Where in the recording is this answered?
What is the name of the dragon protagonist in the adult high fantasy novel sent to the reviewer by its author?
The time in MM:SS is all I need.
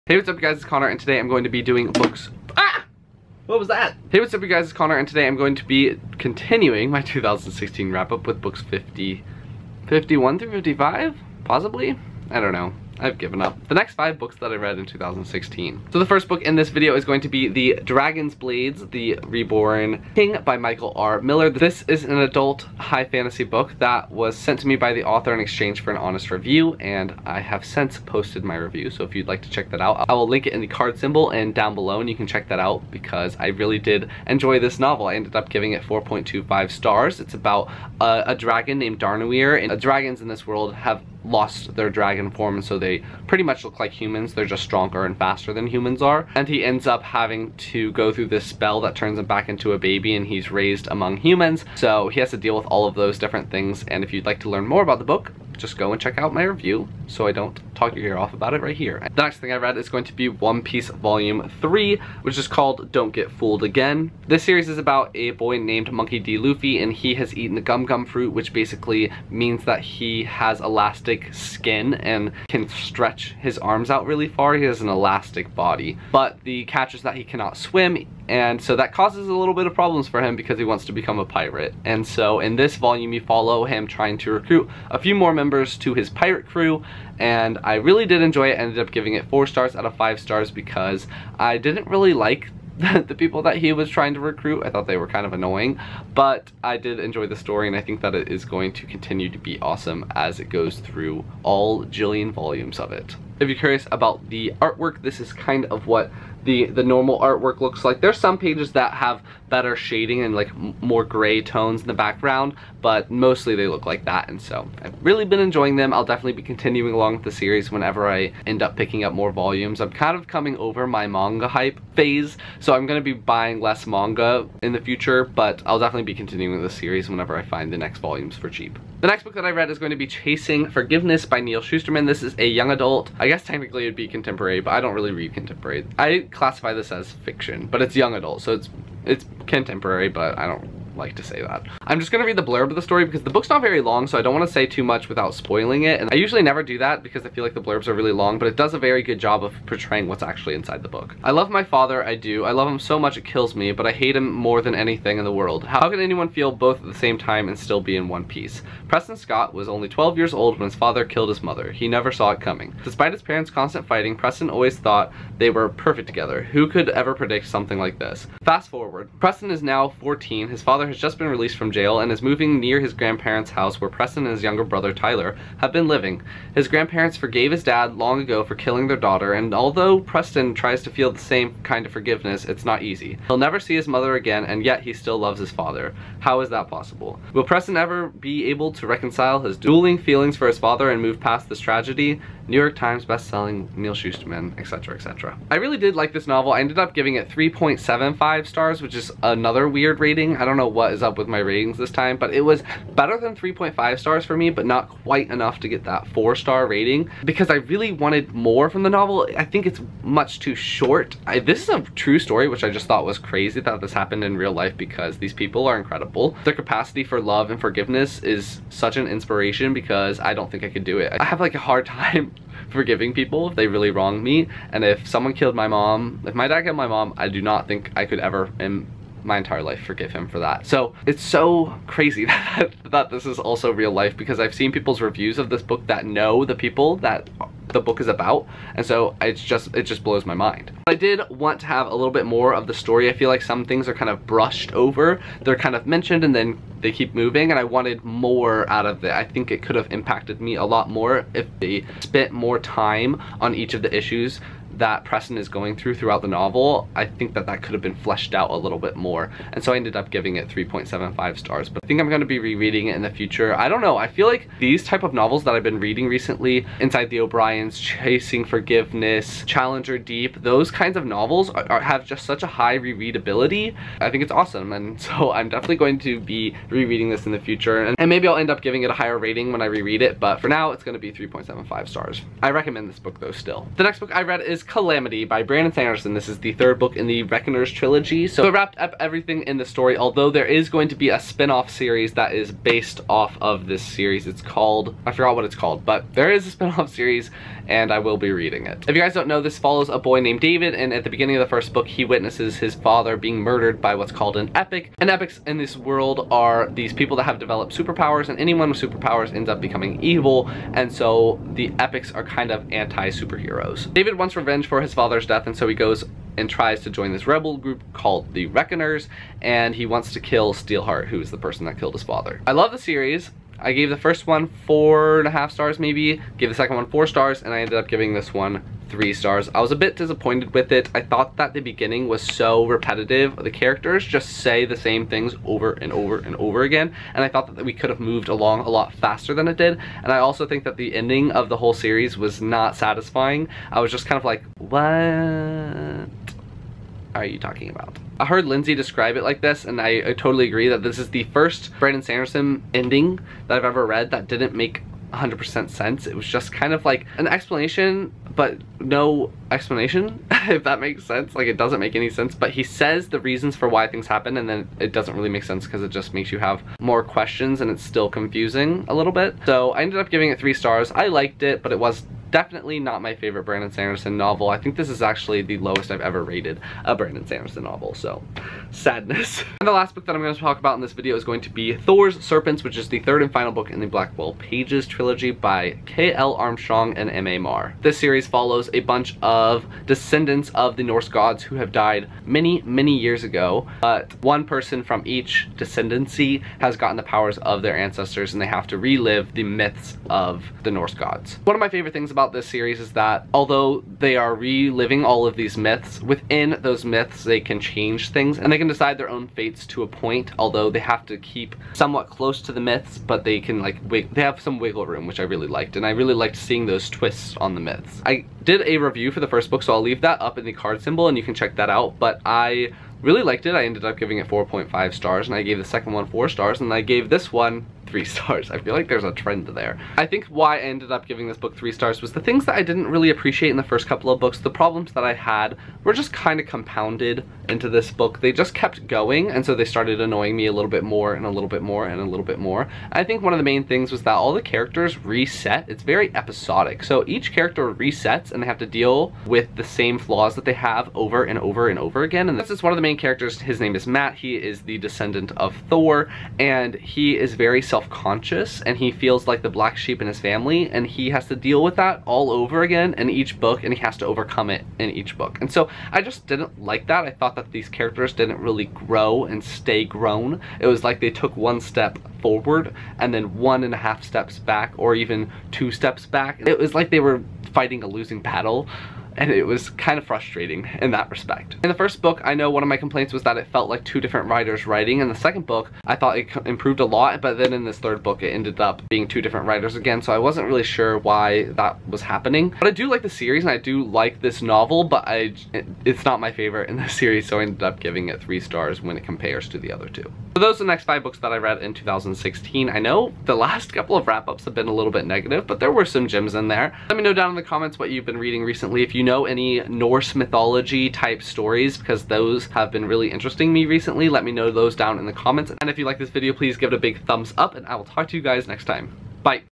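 00:38.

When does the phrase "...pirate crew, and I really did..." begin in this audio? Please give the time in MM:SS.
01:26.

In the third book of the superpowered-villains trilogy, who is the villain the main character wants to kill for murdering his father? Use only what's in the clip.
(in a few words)
Steelheart.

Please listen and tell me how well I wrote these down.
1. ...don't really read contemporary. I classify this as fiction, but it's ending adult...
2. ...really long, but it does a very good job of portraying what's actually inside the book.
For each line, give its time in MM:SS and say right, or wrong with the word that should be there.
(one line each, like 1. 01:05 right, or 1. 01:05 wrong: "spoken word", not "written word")
1. 02:14 wrong: "young", not "ending"
2. 02:27 right.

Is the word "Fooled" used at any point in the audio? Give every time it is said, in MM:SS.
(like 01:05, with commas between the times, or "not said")
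01:03.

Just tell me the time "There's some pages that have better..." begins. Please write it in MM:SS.
01:48.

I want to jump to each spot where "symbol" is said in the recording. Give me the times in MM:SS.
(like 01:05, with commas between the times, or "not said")
00:30, 07:00.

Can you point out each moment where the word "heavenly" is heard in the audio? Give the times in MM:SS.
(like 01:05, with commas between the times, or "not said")
not said.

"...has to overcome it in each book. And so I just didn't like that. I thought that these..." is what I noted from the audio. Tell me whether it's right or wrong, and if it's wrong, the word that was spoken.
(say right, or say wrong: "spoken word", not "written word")
right.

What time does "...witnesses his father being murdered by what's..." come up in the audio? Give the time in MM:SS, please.
05:02.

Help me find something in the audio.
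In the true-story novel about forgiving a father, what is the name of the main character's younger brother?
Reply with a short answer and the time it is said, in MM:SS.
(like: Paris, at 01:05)
Tyler, at 02:54.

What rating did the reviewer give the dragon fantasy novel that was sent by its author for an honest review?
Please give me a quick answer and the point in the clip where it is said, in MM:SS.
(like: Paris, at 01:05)
4.25 stars, at 00:35.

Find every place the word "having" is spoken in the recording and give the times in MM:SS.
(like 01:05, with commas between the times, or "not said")
00:47.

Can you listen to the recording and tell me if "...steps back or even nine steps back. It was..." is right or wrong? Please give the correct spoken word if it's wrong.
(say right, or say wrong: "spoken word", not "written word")
wrong: "two", not "nine".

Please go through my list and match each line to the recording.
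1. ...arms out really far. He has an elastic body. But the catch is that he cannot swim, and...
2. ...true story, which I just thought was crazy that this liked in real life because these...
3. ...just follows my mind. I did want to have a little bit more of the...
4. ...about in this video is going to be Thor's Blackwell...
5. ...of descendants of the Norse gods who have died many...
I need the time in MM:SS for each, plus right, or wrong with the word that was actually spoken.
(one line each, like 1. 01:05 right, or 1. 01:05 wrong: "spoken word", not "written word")
1. 01:13 right
2. 03:31 wrong: "happened", not "liked"
3. 03:59 wrong: "blows", not "follows"
4. 06:20 wrong: "Serpents", not "Blackwell"
5. 06:29 right.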